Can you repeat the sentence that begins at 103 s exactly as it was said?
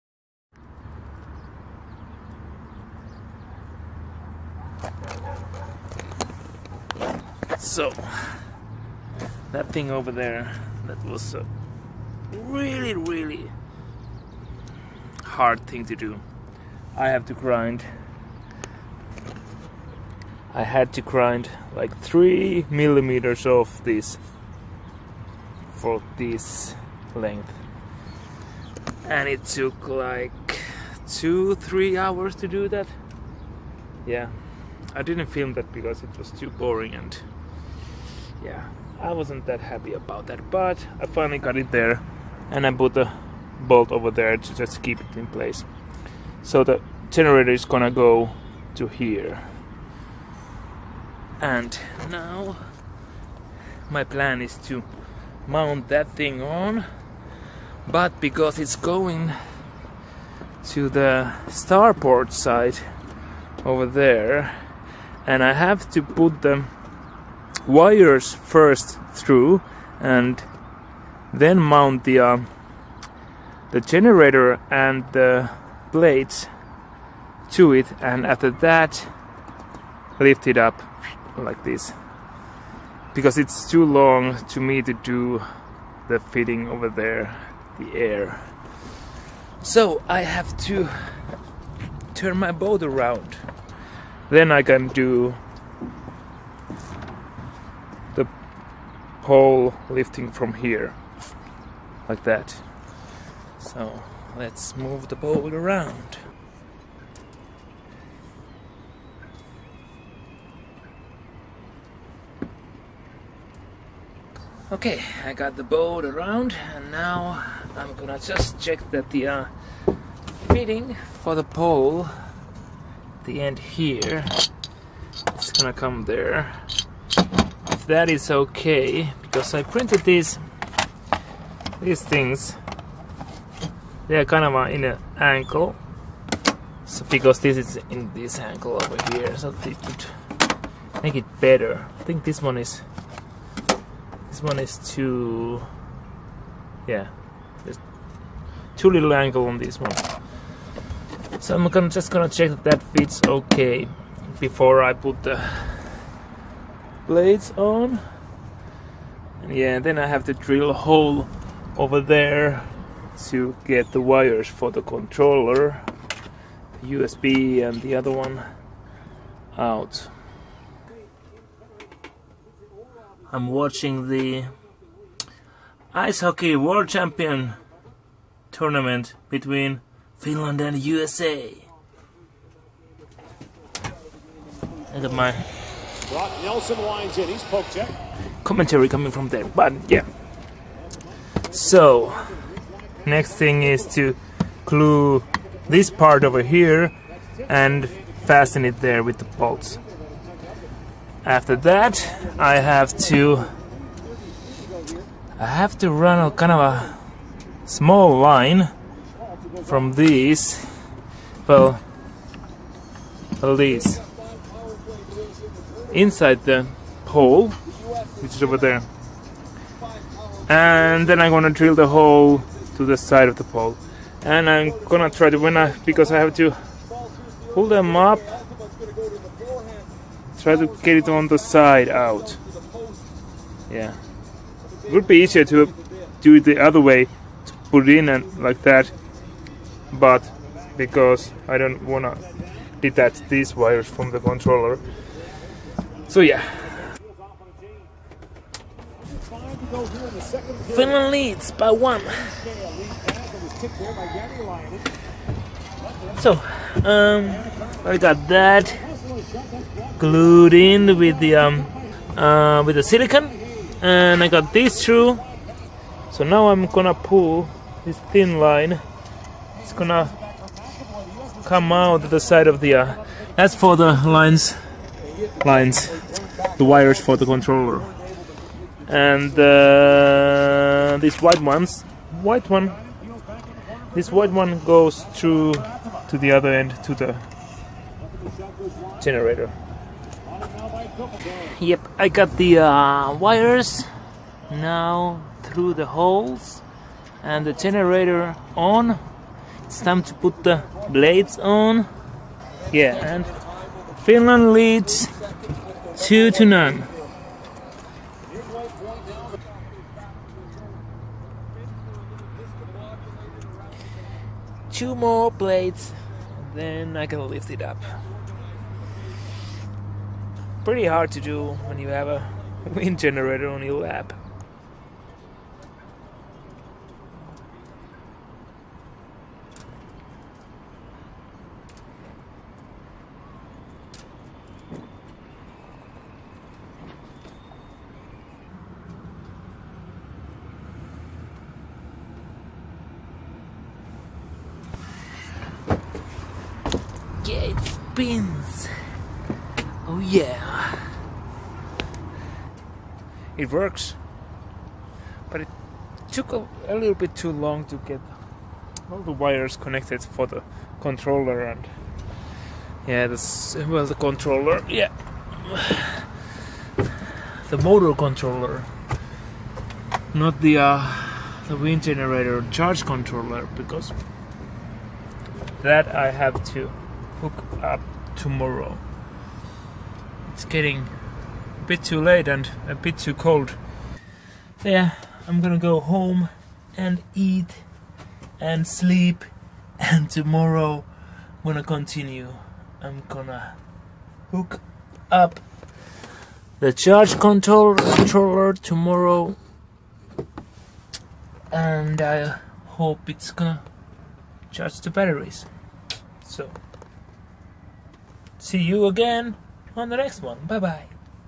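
So let's move the pole around.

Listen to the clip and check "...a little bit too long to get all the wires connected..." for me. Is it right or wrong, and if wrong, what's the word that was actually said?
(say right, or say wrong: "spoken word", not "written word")
right.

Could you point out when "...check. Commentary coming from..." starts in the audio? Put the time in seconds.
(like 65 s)
187 s.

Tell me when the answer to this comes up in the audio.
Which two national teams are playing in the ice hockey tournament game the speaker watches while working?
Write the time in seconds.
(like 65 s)
180 s.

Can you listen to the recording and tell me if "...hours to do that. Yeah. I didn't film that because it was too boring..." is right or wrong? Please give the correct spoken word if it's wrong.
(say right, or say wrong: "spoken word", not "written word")
right.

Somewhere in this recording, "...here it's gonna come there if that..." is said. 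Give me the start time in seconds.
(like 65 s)
123 s.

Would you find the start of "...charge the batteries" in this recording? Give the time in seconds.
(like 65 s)
404 s.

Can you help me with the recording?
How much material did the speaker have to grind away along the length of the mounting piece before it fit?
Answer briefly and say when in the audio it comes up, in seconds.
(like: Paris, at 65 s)
3 millimeters, at 21 s.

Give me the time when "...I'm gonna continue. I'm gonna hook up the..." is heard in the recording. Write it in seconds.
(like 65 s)
390 s.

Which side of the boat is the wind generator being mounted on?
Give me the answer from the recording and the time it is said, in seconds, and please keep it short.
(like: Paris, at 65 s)
Starboard, at 61 s.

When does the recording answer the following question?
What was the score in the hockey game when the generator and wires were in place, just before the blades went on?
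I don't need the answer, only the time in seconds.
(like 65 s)
305 s.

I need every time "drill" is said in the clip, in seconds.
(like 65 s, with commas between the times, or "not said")
160 s, 221 s.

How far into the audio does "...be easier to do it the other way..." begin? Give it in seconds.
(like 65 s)
235 s.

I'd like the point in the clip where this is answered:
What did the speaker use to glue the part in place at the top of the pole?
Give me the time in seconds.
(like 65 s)
262 s.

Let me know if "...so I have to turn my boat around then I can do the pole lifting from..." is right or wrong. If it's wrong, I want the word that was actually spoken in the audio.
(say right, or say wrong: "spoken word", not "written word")
right.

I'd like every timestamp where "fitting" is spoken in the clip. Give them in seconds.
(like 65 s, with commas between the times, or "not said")
86 s, 120 s.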